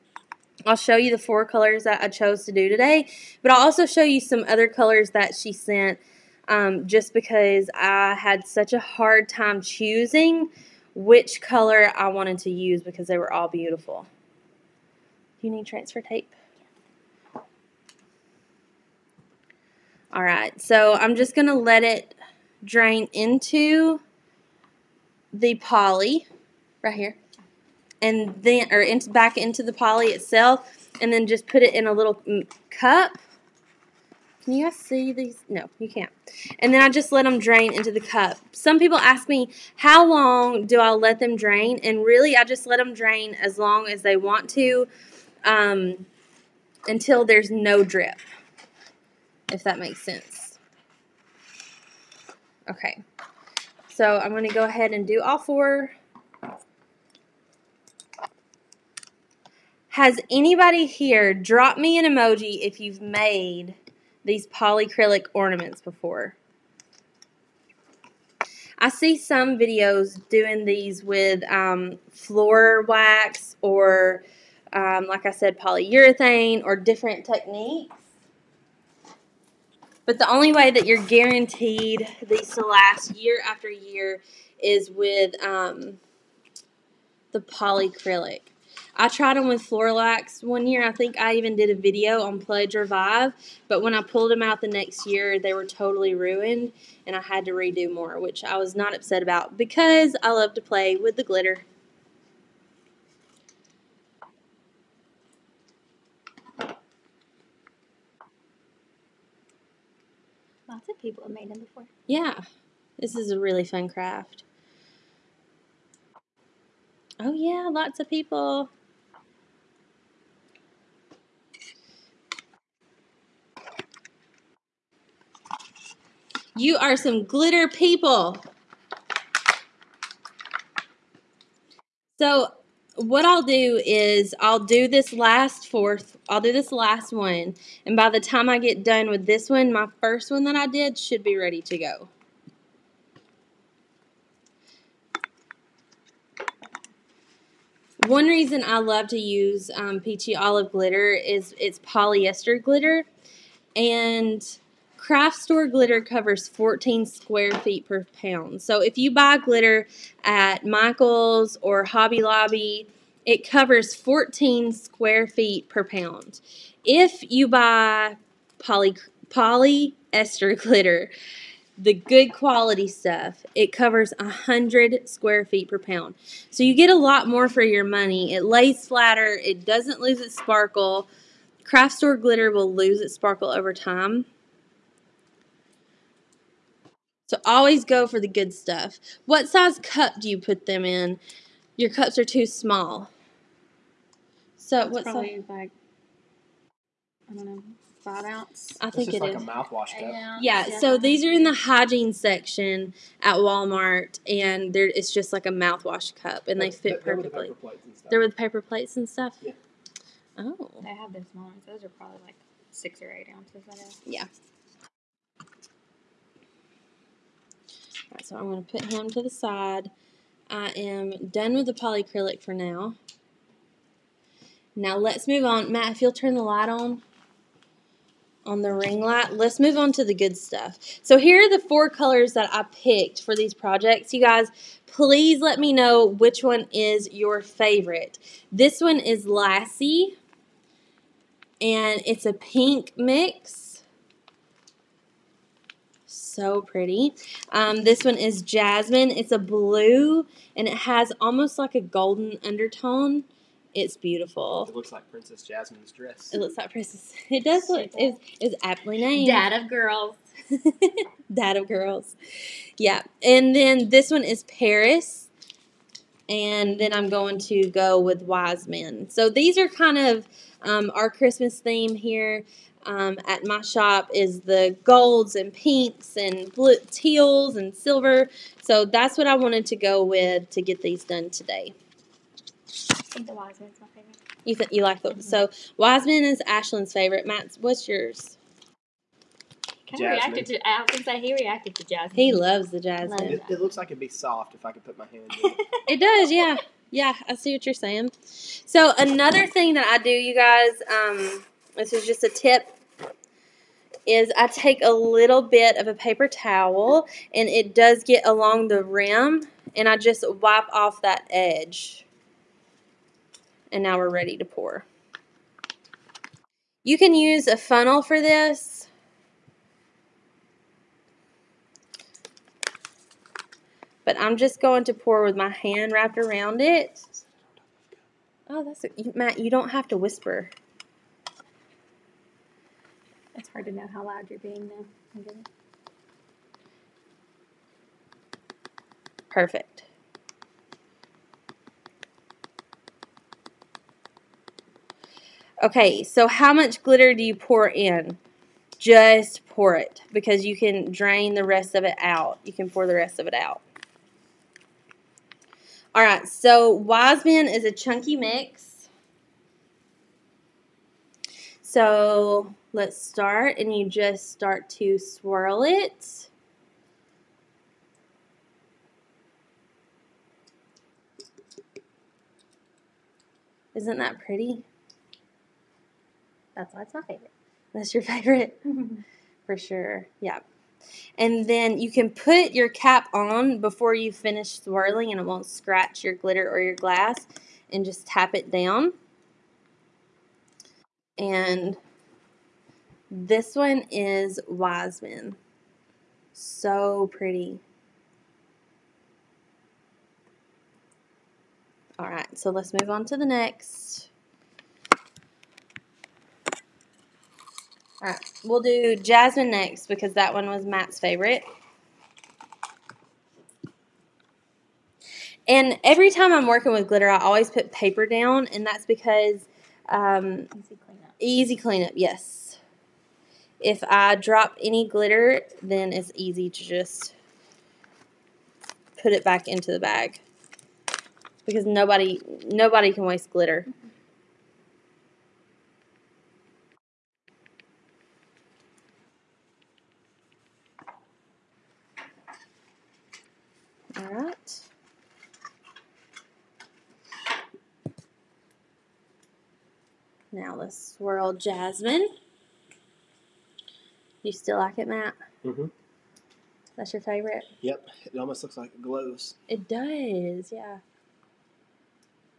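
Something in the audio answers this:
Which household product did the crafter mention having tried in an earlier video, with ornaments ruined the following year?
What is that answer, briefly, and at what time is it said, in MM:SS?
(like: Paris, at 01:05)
Pledge Revive, at 01:32.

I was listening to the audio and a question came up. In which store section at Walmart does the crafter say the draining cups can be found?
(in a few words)
hygiene section.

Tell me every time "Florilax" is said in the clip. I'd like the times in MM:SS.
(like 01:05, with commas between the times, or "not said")
01:29.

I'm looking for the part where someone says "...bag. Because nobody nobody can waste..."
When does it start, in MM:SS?
07:09.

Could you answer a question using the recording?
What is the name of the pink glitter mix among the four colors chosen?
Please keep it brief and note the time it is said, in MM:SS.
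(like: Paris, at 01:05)
Lassie, at 03:59.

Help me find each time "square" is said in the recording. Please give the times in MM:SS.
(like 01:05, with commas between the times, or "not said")
02:37, 02:44, 02:55.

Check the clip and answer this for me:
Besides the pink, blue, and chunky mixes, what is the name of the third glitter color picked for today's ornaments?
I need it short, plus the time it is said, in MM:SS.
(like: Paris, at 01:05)
Paris, at 04:24.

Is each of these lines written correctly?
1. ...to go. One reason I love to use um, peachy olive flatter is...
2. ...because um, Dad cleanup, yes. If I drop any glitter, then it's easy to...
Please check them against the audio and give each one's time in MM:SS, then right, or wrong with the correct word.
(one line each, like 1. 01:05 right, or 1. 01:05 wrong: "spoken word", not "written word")
1. 02:21 wrong: "glitter", not "flatter"
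2. 06:58 wrong: "Easy", not "Dad".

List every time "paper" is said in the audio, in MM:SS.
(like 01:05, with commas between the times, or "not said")
03:28, 05:05, 06:57.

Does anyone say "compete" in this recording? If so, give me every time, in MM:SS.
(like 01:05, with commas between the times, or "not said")
not said.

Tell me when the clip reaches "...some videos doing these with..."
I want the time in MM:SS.
01:09.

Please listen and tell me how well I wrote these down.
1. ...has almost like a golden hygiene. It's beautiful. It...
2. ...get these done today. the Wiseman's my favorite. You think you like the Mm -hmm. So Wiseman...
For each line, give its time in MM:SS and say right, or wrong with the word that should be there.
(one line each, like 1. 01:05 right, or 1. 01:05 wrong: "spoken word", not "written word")
1. 04:10 wrong: "undertone", not "hygiene"
2. 04:40 right.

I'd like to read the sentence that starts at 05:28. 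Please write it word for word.
Oh, that's a, Matt, you don't have to whisper.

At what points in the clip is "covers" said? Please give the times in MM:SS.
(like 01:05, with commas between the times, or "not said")
02:36, 02:43, 02:53.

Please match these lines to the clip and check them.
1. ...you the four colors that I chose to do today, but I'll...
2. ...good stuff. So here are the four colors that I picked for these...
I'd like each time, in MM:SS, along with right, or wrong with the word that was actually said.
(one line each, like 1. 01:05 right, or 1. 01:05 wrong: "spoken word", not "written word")
1. 00:00 right
2. 03:50 right.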